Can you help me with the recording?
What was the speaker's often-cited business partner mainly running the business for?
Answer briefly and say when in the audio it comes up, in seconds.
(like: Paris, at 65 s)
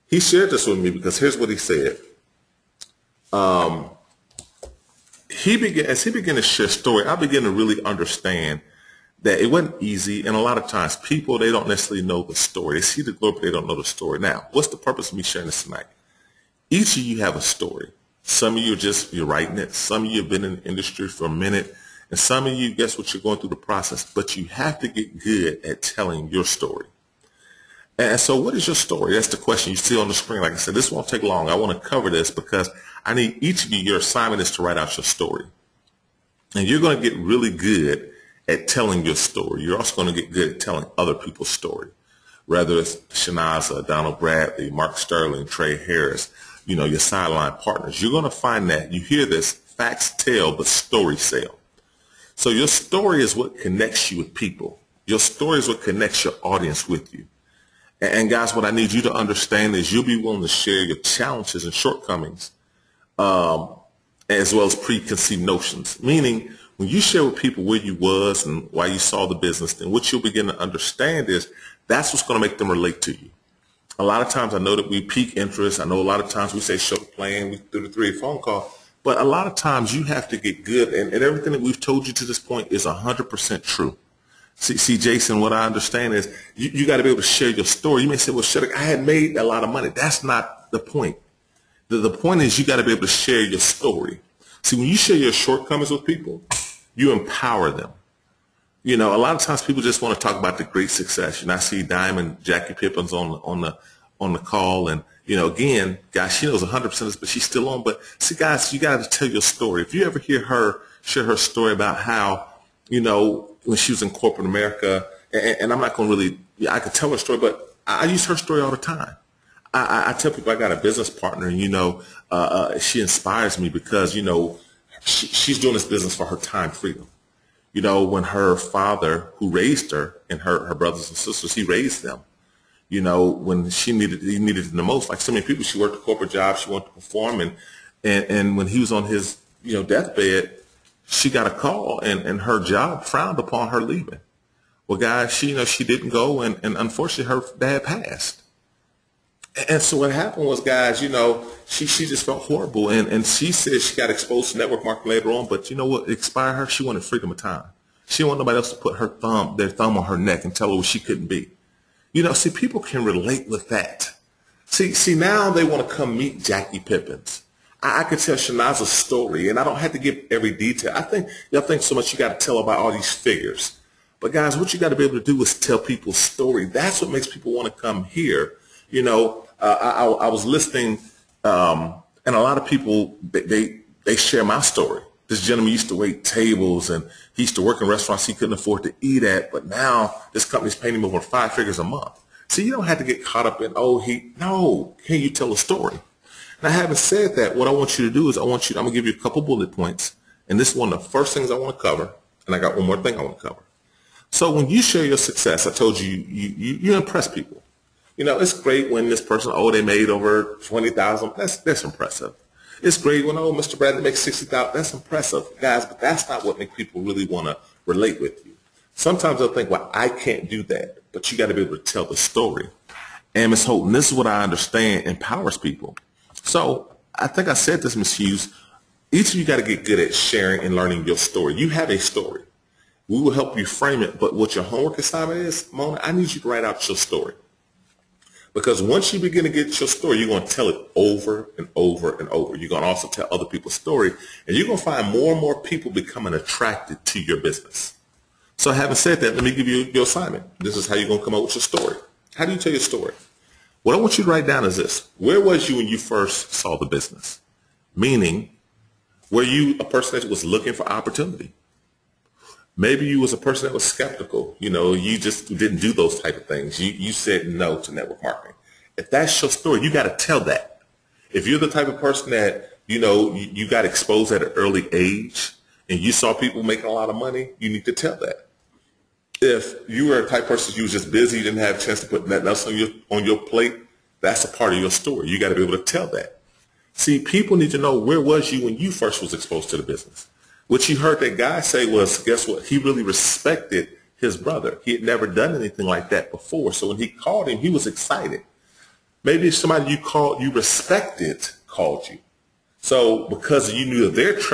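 Time freedom, at 126 s.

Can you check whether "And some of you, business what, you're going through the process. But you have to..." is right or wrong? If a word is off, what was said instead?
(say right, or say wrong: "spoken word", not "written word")
wrong: "guess", not "business".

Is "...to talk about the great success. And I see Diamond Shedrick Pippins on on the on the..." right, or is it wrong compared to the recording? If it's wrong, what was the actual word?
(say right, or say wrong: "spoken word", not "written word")
wrong: "Jackie", not "Shedrick".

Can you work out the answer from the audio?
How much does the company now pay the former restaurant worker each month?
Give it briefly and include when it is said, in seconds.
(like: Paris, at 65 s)
Over five figures, at 191 s.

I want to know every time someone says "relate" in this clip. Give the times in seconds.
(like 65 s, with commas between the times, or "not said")
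72 s, 163 s, 217 s.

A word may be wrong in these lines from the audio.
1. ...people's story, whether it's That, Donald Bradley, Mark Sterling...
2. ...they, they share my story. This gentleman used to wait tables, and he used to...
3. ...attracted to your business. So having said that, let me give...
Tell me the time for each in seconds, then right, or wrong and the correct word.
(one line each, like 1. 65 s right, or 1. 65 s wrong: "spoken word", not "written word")
1. 41 s wrong: "Shanaza", not "That"
2. 183 s right
3. 246 s right.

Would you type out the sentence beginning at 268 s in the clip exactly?
If that's your story, you got to tell that.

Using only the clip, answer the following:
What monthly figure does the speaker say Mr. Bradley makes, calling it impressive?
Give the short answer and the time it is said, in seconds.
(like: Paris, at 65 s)
60000, at 214 s.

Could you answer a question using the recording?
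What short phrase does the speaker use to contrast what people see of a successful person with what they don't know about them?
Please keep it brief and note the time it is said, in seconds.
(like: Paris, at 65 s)
They see the glory, at 12 s.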